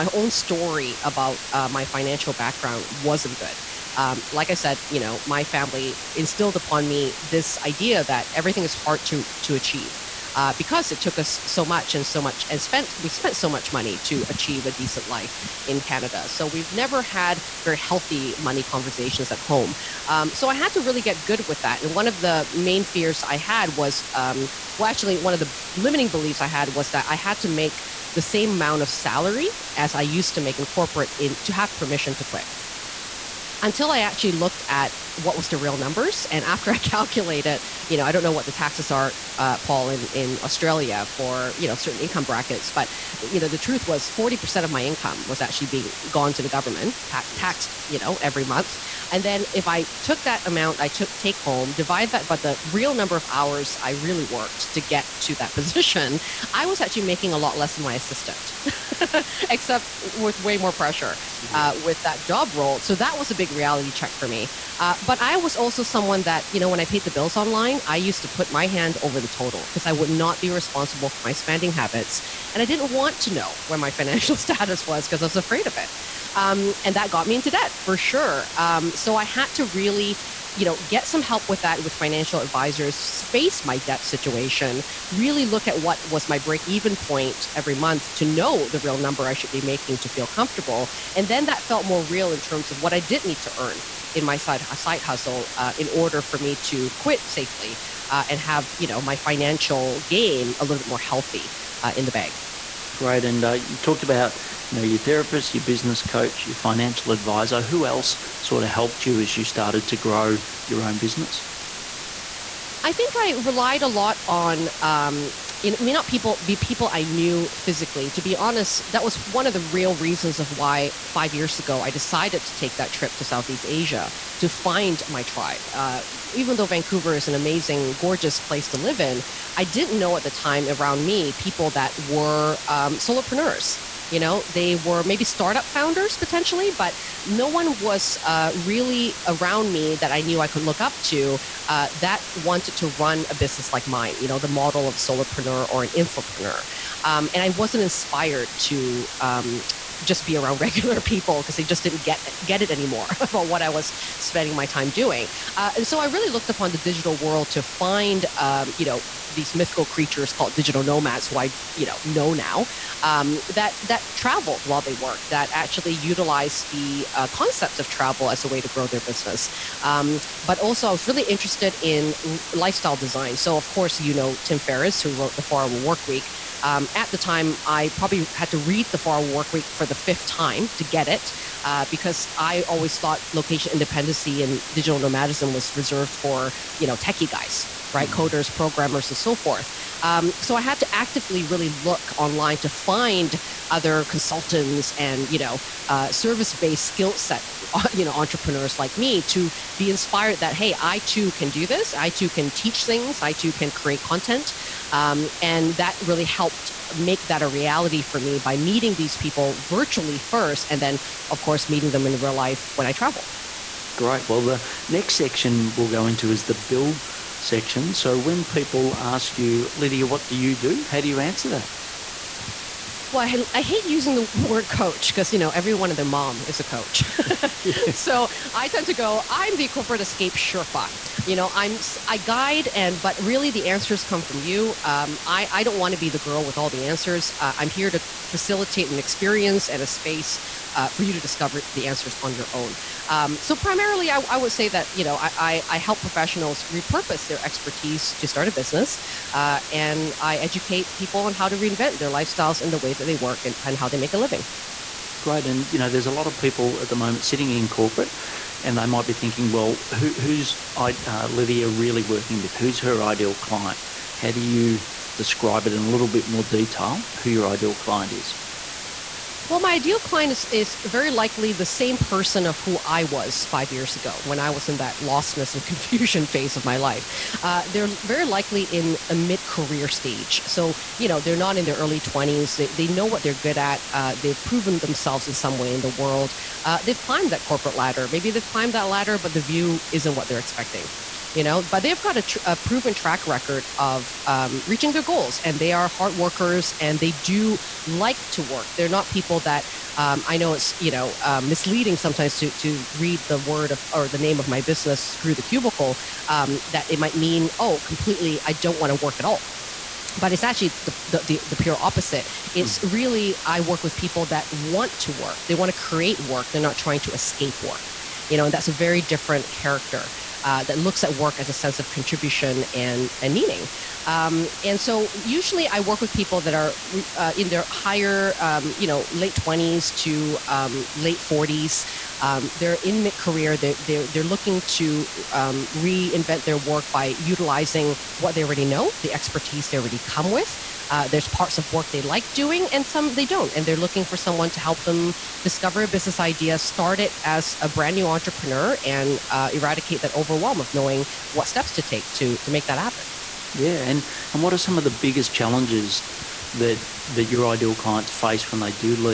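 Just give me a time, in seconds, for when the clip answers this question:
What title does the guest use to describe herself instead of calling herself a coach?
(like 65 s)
229 s.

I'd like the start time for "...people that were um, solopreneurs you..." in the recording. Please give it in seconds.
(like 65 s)
131 s.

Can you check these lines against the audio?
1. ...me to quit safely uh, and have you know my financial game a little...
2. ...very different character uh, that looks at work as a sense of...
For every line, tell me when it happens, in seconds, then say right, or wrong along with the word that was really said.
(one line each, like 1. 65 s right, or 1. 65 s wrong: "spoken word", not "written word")
1. 96 s right
2. 318 s right.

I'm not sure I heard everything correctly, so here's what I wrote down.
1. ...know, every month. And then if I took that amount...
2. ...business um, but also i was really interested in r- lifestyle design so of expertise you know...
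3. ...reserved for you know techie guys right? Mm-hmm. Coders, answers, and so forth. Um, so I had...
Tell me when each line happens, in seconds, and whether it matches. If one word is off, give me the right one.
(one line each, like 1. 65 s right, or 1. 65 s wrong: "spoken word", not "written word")
1. 47 s right
2. 169 s wrong: "course", not "expertise"
3. 185 s wrong: "programmers", not "answers".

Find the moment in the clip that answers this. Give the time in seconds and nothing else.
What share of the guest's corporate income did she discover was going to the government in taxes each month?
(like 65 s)
44 s.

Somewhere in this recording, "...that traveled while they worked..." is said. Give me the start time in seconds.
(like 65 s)
163 s.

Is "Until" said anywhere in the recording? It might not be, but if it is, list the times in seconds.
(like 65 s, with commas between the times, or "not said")
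33 s.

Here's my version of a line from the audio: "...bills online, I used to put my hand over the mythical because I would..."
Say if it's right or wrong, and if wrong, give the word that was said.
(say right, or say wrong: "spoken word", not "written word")
wrong: "total", not "mythical".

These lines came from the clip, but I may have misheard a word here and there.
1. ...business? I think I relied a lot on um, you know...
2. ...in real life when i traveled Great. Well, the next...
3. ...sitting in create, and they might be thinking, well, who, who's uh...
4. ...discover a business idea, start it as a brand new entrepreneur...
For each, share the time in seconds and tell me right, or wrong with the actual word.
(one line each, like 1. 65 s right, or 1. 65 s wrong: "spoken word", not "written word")
1. 110 s right
2. 212 s right
3. 257 s wrong: "corporate", not "create"
4. 345 s right.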